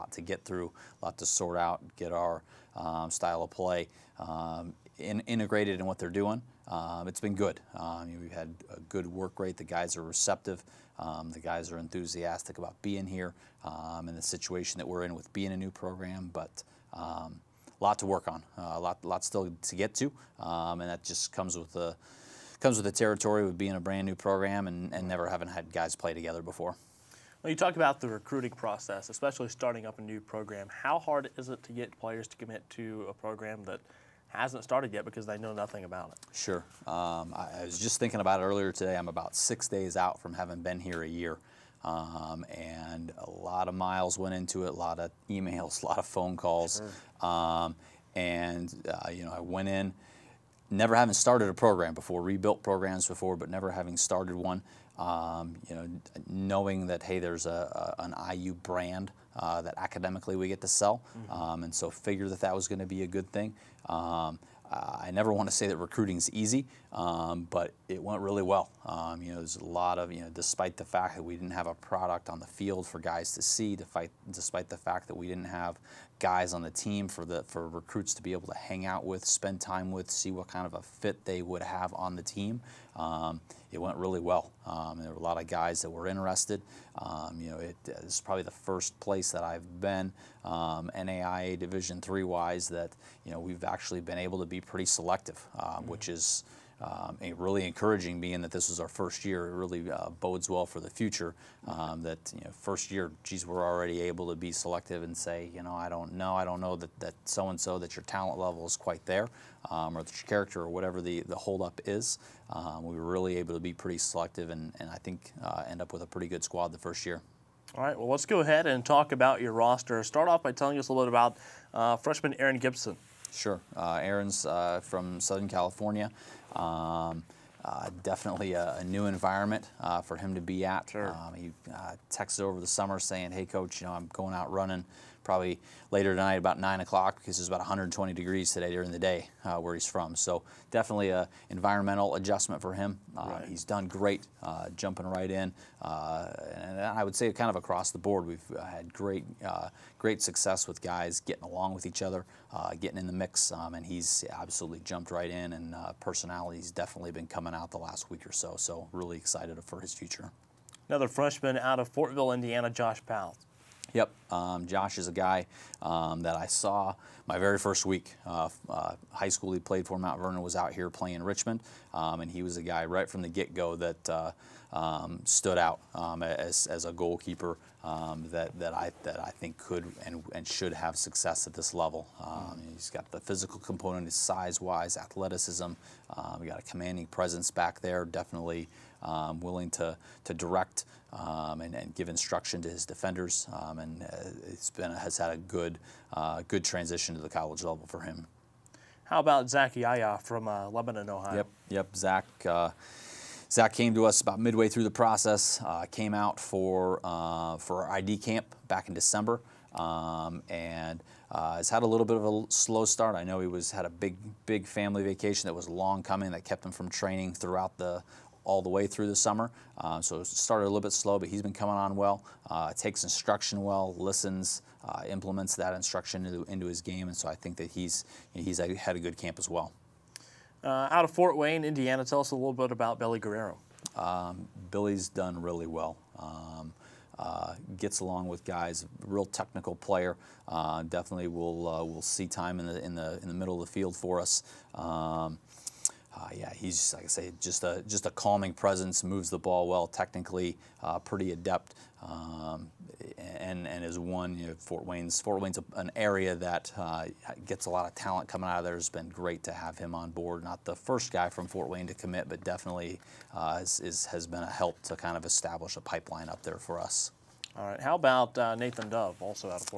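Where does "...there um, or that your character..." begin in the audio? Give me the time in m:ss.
1:49.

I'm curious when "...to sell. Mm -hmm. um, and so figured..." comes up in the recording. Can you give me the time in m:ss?
1:00.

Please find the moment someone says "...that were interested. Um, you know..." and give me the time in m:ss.
1:25.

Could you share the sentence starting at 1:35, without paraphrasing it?
which is um, really encouraging being that this is our first year.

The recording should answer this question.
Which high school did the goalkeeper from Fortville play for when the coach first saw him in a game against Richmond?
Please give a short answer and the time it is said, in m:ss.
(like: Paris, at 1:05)
Mount Vernon, at 2:49.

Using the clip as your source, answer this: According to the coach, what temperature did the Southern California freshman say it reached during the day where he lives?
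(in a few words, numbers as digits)
120 degrees.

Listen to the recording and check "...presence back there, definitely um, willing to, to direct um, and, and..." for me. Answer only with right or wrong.
right.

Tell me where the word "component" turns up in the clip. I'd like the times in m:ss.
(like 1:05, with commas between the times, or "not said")
3:03.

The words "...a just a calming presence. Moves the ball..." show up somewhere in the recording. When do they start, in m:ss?
4:07.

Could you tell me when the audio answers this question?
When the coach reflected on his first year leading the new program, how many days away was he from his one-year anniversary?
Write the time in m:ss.
0:39.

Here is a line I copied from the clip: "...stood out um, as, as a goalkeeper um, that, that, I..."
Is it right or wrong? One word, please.
right.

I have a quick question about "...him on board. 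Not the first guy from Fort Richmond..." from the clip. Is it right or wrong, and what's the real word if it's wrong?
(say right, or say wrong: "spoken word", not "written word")
wrong: "Wayne", not "Richmond".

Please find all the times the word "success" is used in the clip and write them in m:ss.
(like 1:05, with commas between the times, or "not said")
2:30, 3:00.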